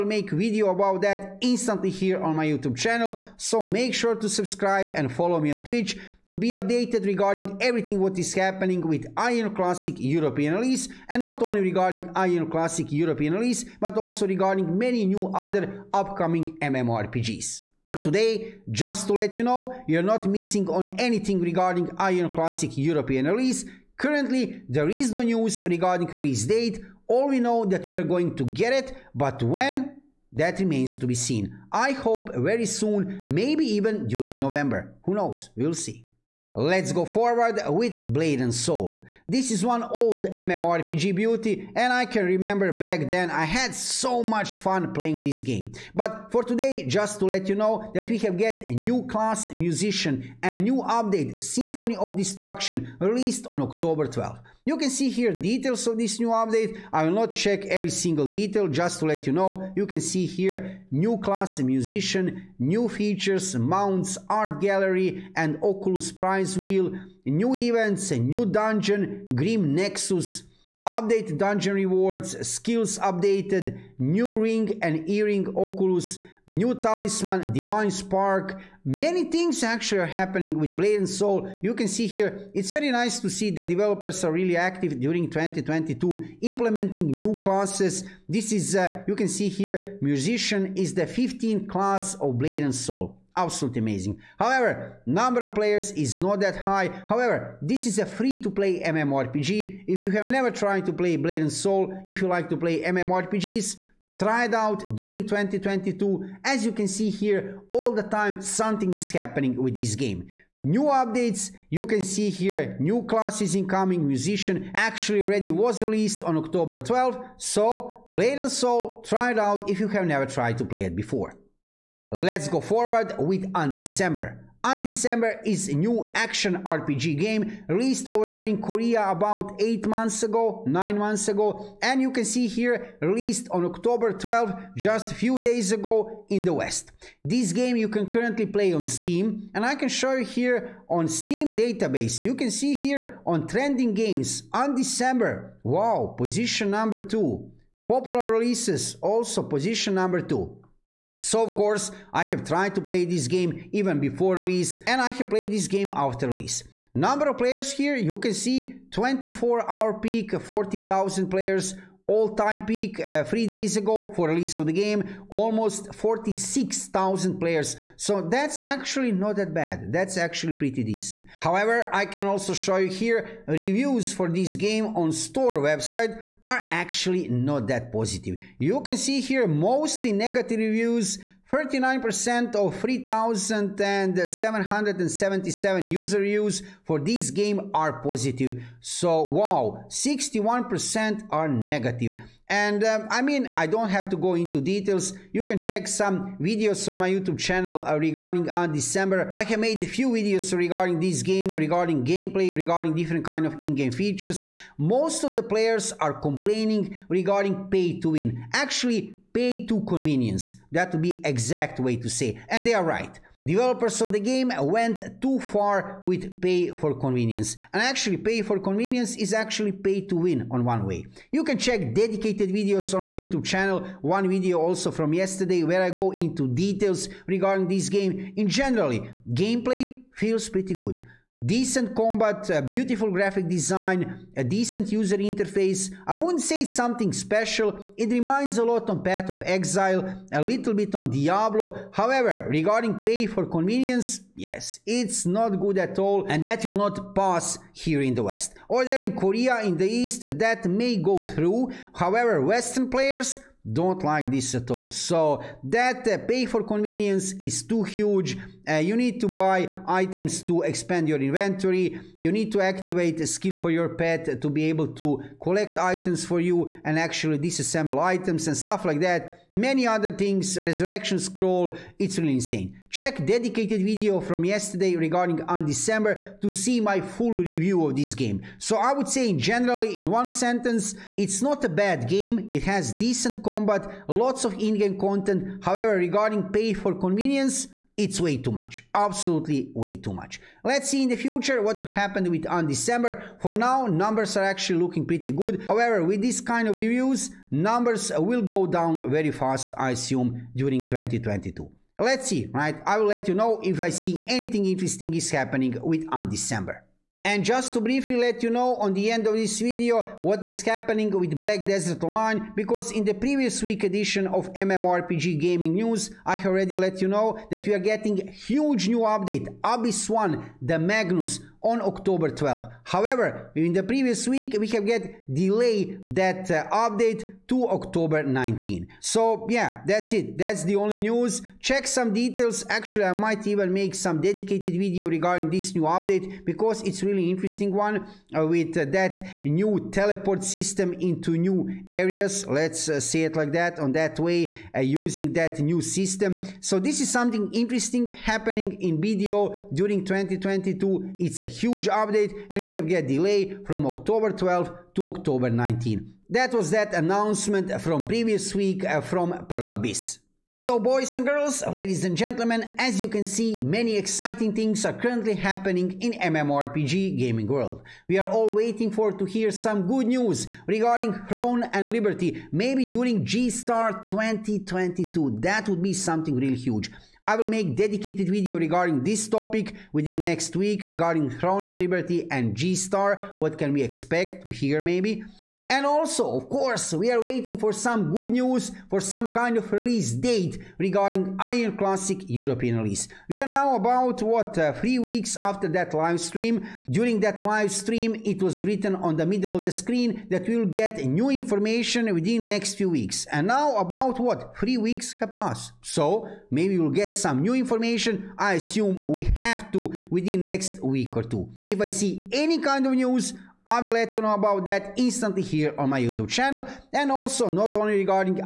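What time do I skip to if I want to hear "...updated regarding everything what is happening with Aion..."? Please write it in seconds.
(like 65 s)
6 s.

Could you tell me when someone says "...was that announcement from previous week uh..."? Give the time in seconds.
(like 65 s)
356 s.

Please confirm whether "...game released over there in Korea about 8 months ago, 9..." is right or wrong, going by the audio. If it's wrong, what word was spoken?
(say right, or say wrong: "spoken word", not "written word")
right.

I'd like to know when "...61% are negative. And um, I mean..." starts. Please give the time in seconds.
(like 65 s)
189 s.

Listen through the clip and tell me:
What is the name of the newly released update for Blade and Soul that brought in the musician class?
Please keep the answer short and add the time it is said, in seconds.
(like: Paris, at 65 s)
Symphony of Destruction, at 51 s.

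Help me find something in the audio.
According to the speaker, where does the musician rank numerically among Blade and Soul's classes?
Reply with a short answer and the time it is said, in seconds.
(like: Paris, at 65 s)
15th, at 91 s.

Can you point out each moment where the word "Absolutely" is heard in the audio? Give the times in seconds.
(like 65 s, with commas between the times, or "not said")
93 s, 288 s.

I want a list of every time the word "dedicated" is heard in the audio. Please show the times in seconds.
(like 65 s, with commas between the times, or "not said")
221 s, 273 s, 334 s, 377 s.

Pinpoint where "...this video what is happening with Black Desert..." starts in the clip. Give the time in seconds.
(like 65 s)
309 s.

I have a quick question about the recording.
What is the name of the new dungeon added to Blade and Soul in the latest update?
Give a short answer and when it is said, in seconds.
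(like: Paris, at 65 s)
Grim Nexus, at 69 s.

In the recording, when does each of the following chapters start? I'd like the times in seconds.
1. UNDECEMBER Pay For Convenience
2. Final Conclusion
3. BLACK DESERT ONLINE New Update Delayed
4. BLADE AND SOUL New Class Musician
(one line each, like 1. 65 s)
1. 121 s
2. 359 s
3. 307 s
4. 36 s.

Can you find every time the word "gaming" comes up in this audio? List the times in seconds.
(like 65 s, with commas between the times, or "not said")
315 s, 367 s.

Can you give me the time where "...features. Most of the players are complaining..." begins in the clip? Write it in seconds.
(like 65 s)
203 s.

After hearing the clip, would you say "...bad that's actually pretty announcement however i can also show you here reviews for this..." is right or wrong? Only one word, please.
wrong.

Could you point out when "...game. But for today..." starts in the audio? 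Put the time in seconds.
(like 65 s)
45 s.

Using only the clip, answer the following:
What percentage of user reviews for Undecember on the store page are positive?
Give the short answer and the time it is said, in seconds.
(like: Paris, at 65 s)
39%, at 181 s.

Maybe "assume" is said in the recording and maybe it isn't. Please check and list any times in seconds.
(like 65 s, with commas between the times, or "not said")
299 s, 408 s.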